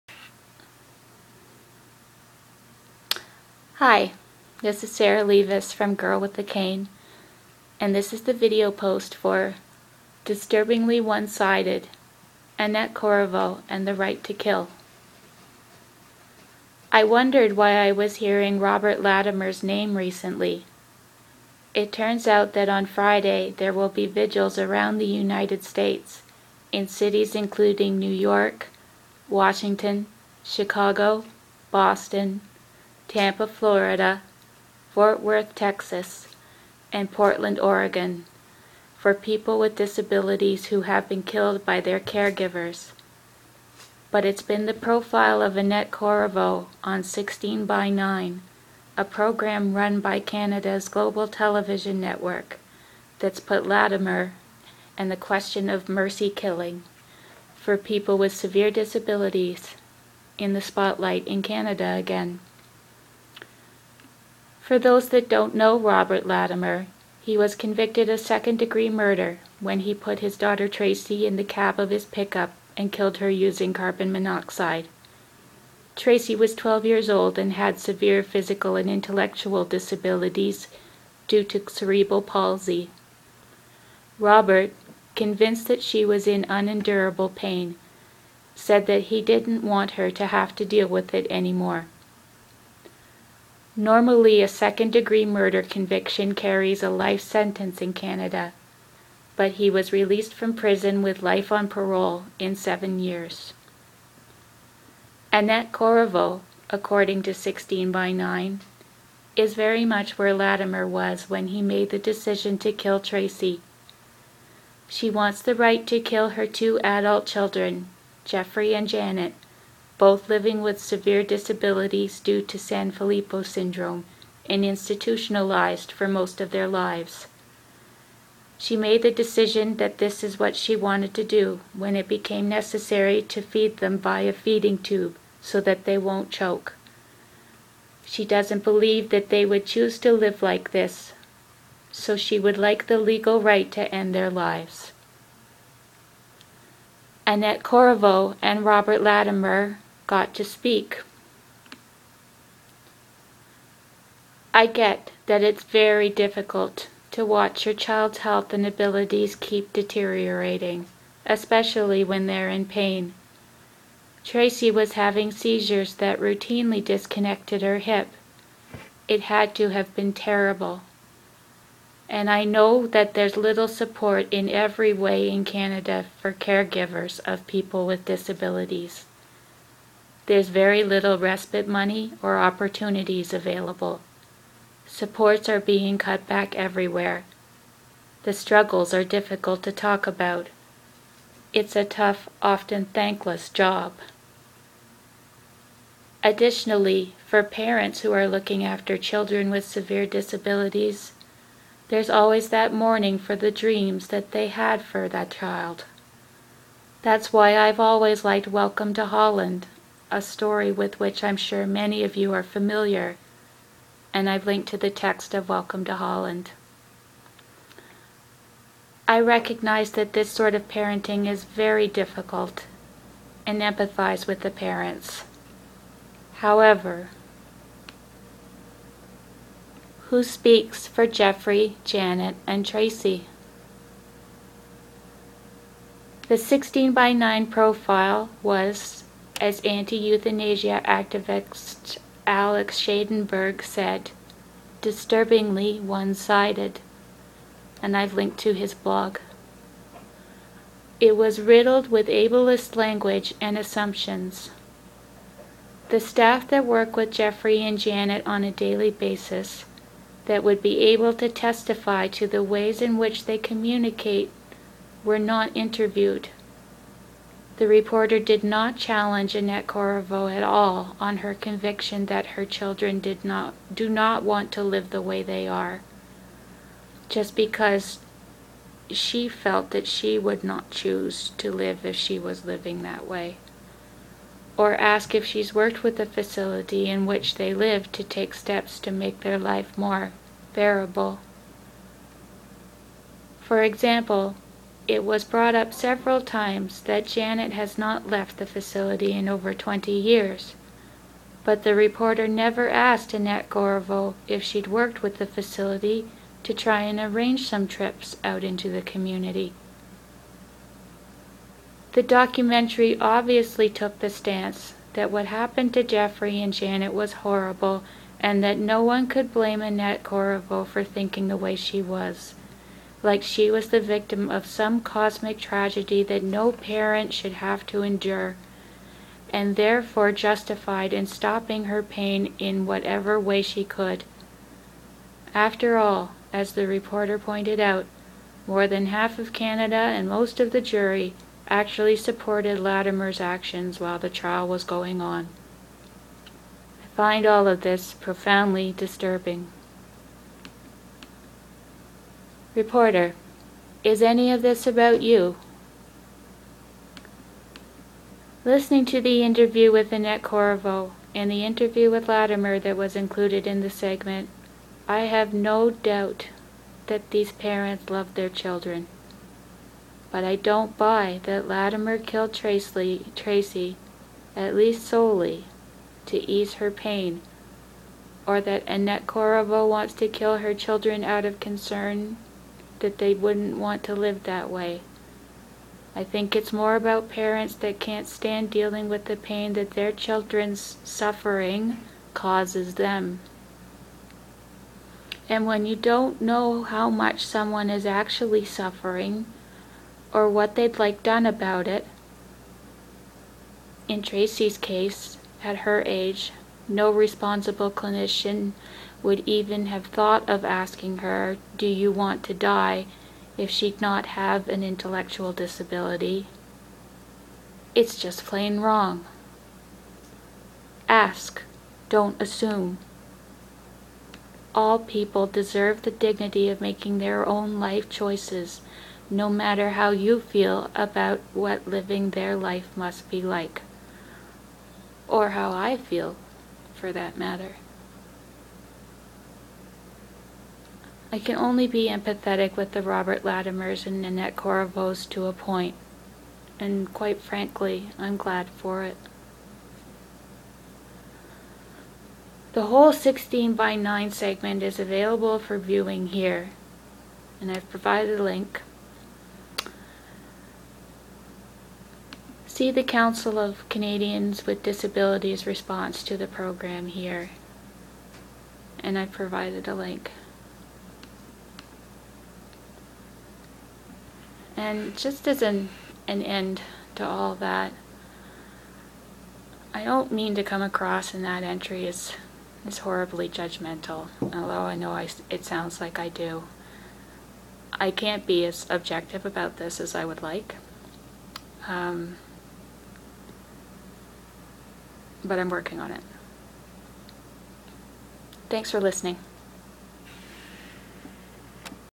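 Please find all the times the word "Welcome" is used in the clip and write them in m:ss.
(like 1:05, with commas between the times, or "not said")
3:28, 3:35.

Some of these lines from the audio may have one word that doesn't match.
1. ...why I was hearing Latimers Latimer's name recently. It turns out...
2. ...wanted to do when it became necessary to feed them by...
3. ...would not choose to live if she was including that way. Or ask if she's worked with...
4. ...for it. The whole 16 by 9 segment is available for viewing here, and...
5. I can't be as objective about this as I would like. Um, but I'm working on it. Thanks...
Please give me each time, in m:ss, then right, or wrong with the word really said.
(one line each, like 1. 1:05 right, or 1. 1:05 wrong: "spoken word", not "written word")
1. 0:17 wrong: "Robert", not "Latimers"
2. 2:10 right
3. 4:40 wrong: "living", not "including"
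4. 7:28 right
5. 8:07 right.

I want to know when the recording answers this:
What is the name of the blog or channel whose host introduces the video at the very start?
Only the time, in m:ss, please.
0:05.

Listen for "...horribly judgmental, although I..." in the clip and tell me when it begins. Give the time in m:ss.
8:02.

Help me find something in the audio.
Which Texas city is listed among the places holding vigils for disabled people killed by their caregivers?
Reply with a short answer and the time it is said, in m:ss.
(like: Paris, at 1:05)
Fort Worth, at 0:34.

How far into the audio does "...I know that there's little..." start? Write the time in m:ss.
2:52.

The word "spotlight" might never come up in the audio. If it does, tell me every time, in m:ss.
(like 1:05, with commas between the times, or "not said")
1:00.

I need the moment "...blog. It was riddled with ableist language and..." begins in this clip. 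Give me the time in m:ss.
4:08.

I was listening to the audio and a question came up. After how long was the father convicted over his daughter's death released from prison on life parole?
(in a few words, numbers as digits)
7 years.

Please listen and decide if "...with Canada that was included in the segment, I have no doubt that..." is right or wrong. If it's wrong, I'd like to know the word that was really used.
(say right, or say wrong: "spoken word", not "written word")
wrong: "Latimer", not "Canada".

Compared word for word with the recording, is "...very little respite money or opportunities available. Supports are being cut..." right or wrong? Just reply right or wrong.
right.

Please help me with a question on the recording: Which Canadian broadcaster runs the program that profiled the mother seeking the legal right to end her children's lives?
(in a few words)
Global Television Network.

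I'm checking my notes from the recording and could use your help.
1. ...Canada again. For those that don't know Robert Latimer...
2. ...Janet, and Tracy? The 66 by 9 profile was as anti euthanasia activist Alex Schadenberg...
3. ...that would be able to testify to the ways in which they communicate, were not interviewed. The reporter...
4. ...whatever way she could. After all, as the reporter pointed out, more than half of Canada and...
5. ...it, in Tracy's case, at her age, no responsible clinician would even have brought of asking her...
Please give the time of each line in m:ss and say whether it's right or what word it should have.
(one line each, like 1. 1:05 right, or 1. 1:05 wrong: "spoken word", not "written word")
1. 1:01 right
2. 3:51 wrong: "16", not "66"
3. 4:20 right
4. 5:32 right
5. 6:41 wrong: "thought", not "brought".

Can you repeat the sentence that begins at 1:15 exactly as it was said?
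Tracy was 12 years old and had severe physical and intellectual disabilities due to cerebral palsy.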